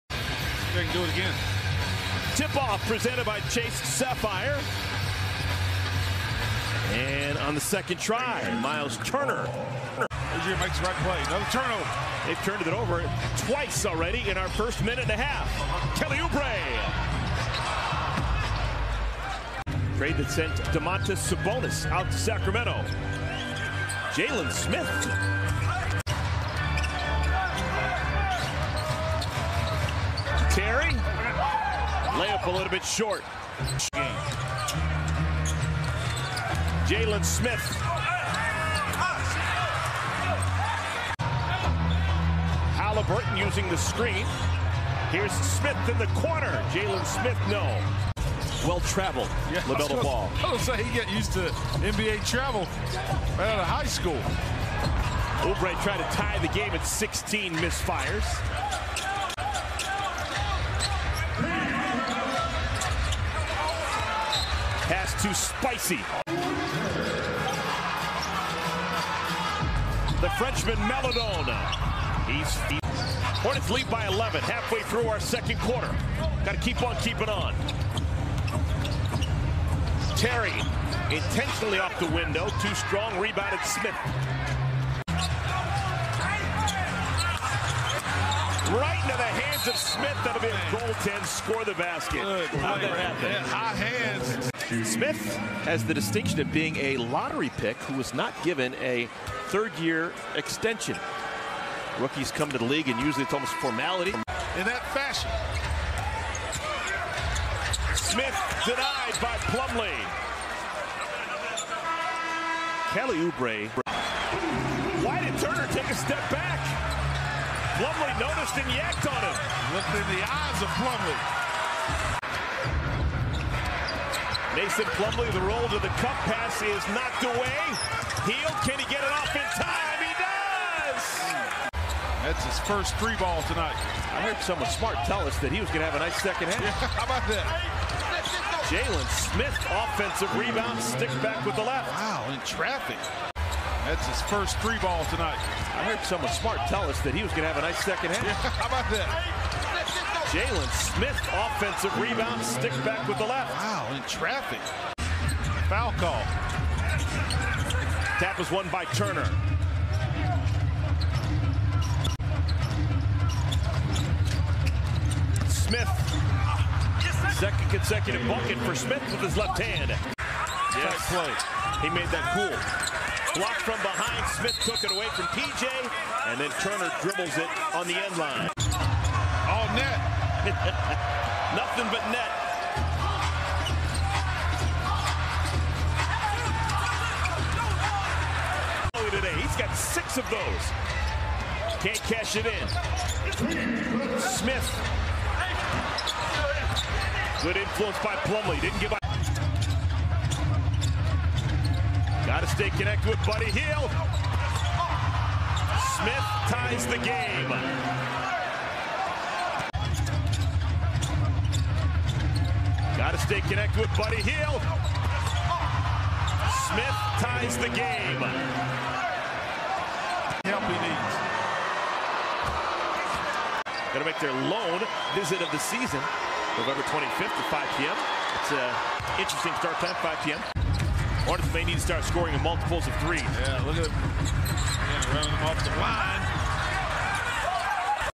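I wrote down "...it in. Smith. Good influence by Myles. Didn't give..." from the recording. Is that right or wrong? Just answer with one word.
wrong.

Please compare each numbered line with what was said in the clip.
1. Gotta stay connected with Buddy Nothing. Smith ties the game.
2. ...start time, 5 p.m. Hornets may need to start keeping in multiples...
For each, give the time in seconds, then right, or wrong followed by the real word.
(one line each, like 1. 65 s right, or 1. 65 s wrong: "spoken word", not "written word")
1. 202 s wrong: "Hield", not "Nothing"
2. 229 s wrong: "scoring", not "keeping".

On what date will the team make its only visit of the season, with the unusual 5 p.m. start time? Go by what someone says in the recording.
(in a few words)
November 25th.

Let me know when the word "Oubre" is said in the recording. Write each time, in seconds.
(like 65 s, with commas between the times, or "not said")
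16 s, 55 s, 113 s.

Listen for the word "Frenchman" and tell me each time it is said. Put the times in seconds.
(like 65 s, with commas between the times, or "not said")
70 s.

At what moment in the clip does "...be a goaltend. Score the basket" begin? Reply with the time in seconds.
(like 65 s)
90 s.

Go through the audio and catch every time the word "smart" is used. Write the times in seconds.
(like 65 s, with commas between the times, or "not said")
134 s, 146 s.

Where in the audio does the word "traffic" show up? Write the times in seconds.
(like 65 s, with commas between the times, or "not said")
142 s, 154 s.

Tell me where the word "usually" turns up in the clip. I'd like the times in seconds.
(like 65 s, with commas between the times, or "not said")
103 s.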